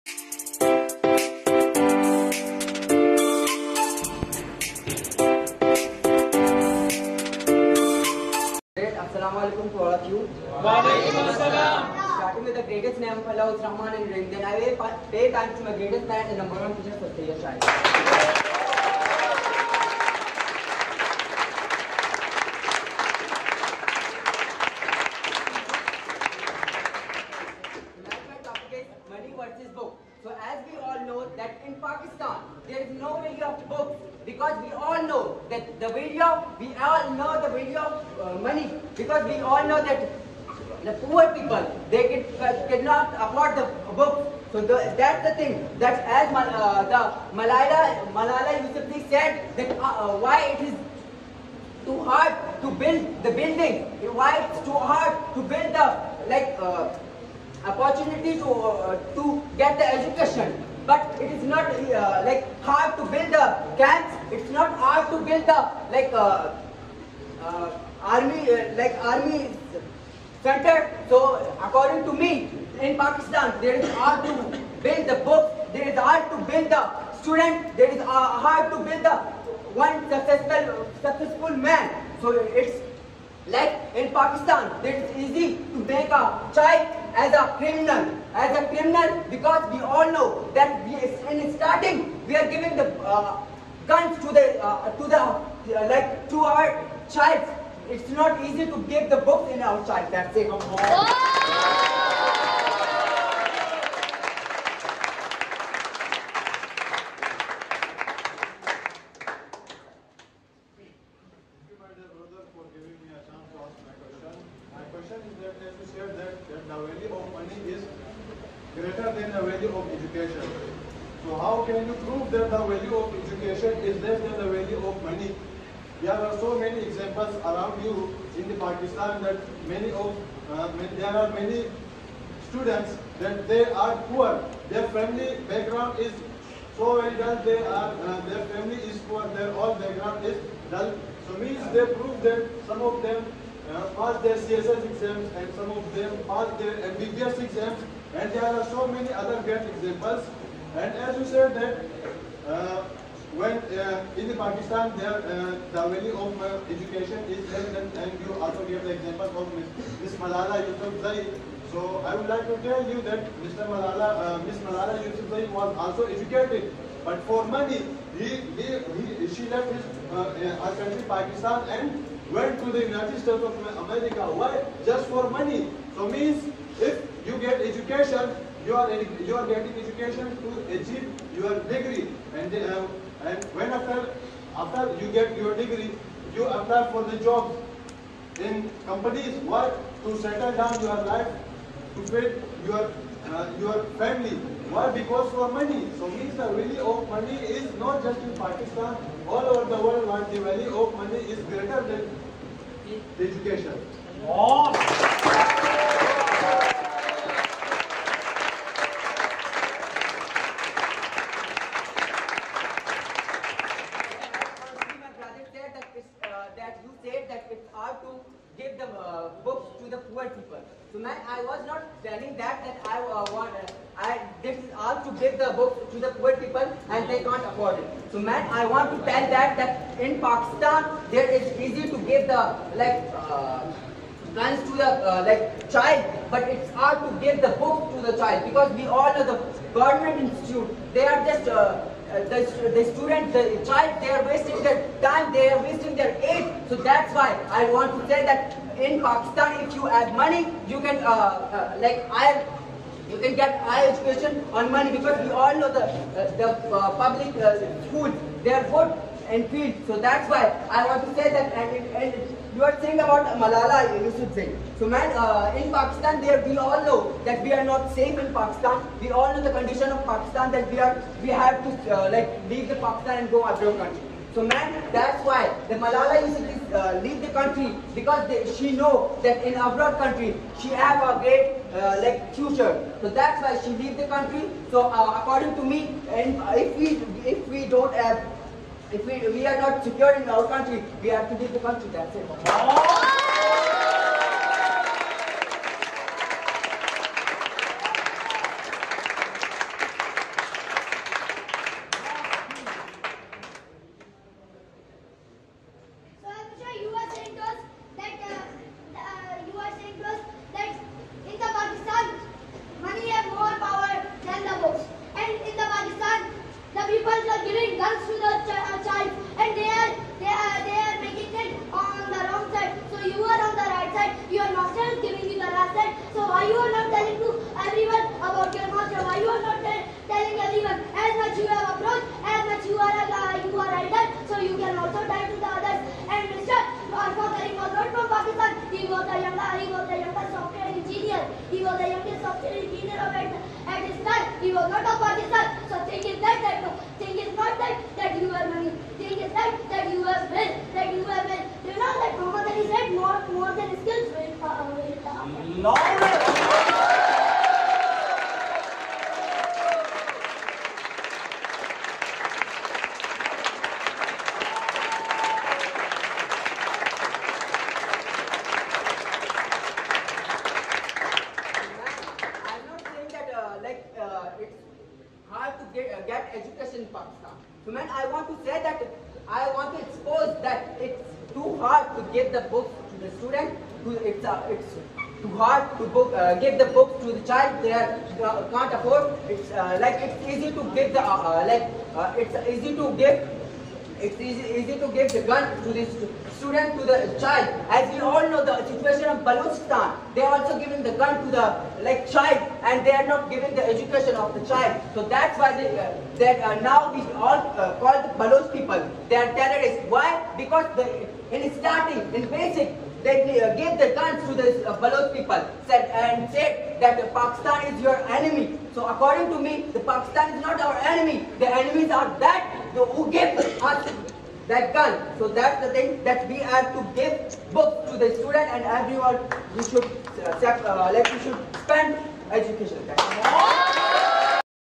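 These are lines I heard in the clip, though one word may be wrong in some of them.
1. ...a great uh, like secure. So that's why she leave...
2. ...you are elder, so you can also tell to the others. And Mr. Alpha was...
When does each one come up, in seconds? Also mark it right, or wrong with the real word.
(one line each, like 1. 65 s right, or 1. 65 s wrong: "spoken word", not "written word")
1. 281 s wrong: "future", not "secure"
2. 333 s right.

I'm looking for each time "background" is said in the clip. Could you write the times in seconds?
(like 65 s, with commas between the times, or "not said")
135 s, 139 s.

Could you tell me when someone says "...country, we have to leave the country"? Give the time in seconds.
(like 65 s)
290 s.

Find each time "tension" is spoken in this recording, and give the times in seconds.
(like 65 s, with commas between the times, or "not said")
not said.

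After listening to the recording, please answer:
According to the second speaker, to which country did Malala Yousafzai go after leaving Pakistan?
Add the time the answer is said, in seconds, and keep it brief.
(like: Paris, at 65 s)
United States of America, at 172 s.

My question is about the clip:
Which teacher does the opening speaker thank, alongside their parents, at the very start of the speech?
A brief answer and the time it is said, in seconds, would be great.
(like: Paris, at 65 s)
Sayyid Shahid, at 17 s.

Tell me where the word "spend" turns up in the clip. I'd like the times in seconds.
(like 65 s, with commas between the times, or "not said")
431 s.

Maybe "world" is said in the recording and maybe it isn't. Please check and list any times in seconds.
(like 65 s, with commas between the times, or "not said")
199 s.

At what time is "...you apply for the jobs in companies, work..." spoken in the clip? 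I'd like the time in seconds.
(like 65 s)
186 s.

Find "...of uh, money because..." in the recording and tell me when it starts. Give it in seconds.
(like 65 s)
37 s.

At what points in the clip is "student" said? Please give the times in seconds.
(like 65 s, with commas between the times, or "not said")
77 s, 132 s, 242 s, 383 s, 396 s, 428 s.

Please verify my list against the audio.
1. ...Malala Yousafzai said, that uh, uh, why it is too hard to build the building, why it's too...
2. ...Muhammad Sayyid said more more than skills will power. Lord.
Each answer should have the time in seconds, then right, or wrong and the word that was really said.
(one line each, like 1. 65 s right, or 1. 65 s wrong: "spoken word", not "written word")
1. 48 s right
2. 352 s wrong: "Ali", not "Sayyid".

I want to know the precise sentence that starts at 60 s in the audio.
But it is not like hard to build the camps.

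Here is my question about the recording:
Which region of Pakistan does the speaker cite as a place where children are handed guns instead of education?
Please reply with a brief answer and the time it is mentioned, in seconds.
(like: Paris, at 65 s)
Balochistan, at 399 s.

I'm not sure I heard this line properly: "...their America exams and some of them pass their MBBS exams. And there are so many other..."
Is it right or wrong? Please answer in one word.
wrong.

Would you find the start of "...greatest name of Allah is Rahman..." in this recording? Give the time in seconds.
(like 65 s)
12 s.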